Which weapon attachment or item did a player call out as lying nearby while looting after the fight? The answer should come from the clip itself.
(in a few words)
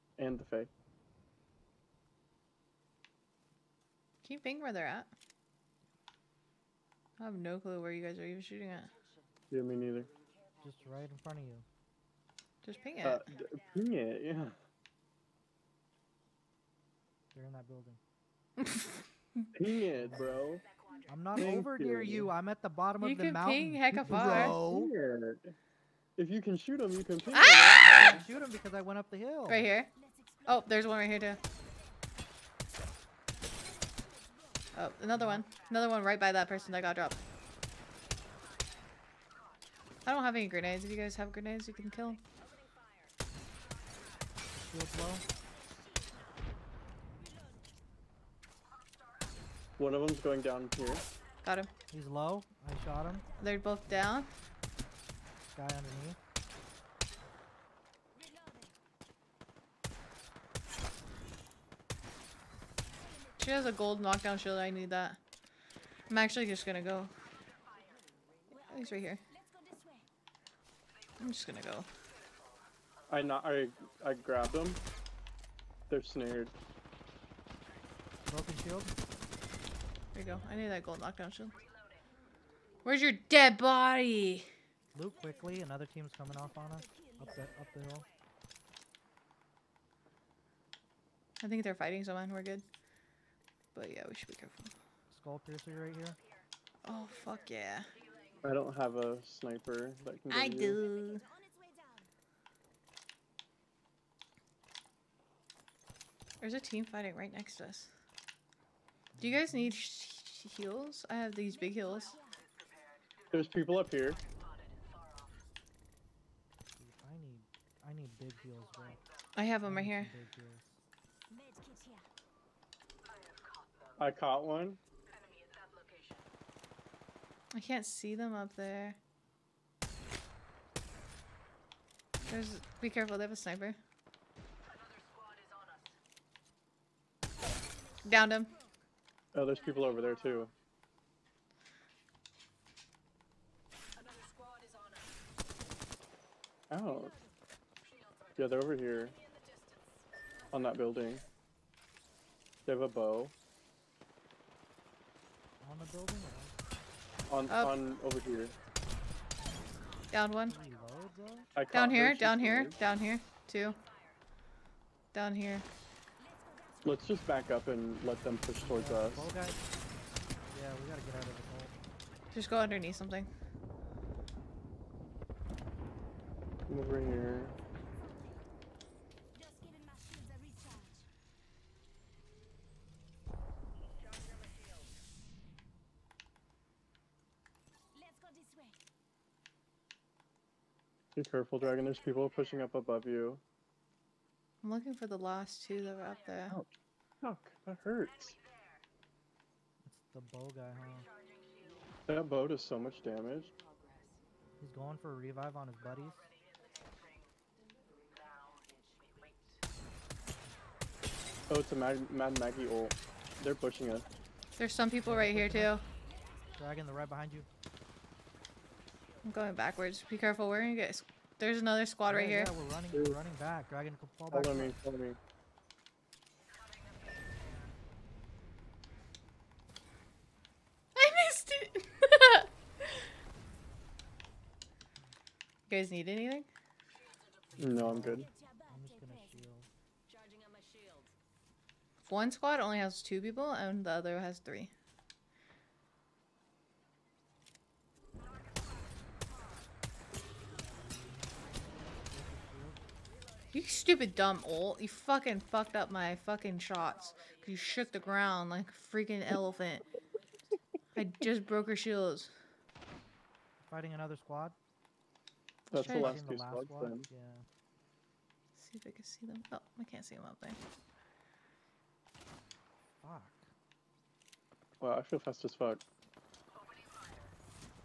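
Skull piercer.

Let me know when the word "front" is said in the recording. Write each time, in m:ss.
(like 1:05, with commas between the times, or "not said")
0:11.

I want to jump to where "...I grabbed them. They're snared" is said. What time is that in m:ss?
1:14.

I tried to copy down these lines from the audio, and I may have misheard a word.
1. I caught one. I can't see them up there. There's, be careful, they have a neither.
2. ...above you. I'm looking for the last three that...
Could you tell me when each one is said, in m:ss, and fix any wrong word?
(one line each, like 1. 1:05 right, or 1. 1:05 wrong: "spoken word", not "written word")
1. 2:03 wrong: "sniper", not "neither"
2. 3:12 wrong: "two", not "three".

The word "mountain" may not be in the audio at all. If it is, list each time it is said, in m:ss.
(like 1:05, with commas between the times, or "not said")
0:23.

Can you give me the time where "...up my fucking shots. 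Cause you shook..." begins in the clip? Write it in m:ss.
4:15.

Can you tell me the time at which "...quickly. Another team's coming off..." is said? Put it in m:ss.
1:25.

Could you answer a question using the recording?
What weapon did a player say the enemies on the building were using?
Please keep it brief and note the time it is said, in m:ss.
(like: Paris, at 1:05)
A bow, at 2:32.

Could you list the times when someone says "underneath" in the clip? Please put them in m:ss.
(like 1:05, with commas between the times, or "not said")
0:55, 2:52.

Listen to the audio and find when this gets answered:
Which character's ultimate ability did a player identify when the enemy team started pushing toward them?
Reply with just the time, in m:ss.
3:32.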